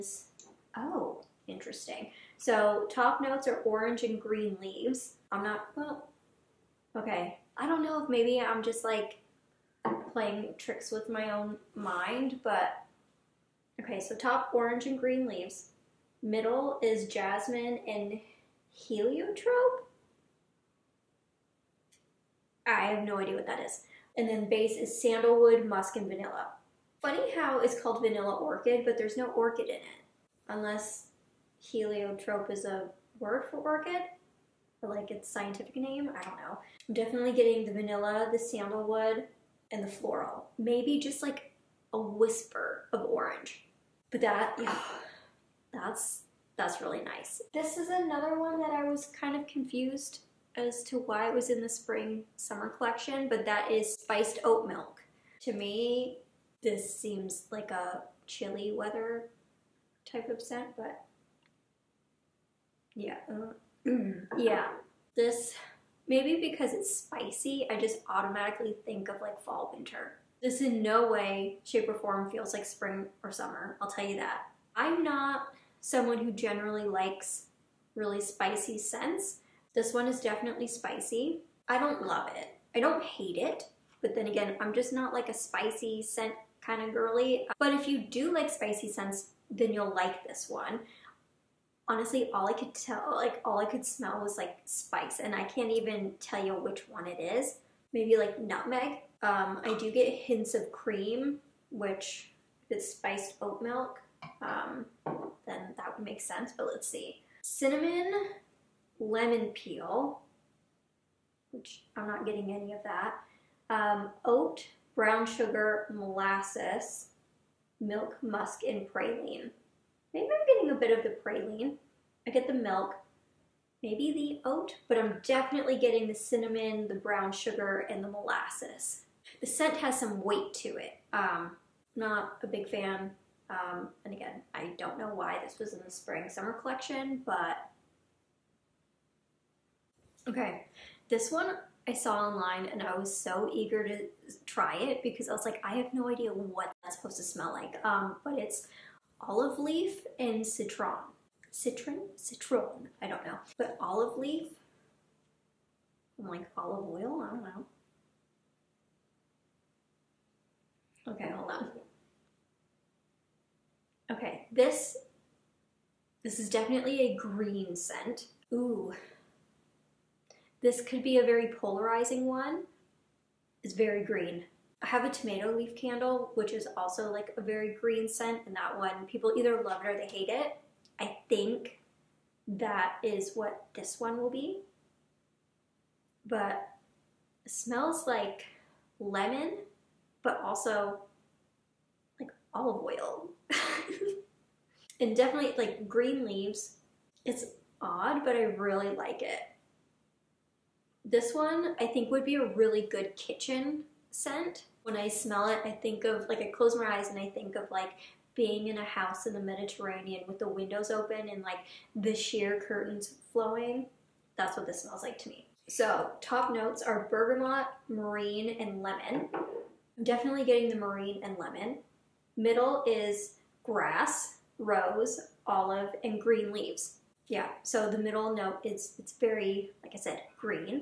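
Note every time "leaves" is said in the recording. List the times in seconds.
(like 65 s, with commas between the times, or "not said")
4 s, 15 s, 196 s, 226 s.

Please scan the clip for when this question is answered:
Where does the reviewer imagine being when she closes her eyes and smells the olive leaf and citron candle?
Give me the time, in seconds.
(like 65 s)
209 s.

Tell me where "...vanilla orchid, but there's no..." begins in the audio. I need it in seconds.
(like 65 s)
28 s.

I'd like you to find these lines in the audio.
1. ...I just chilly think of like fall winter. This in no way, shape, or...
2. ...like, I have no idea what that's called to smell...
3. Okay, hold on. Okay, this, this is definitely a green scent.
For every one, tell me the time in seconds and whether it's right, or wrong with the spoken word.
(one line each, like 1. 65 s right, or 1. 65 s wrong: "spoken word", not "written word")
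1. 67 s wrong: "automatically", not "chilly"
2. 145 s wrong: "supposed", not "called"
3. 161 s right.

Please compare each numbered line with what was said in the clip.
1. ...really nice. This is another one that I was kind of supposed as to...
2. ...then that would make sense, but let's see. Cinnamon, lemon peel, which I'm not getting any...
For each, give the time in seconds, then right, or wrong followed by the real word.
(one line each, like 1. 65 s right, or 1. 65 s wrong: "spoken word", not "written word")
1. 46 s wrong: "confused", not "supposed"
2. 105 s right.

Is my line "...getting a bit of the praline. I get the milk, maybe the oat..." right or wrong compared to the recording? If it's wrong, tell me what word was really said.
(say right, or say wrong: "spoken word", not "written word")
right.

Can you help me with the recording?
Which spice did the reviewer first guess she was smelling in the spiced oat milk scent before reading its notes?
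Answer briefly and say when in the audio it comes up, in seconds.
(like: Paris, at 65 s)
Nutmeg, at 98 s.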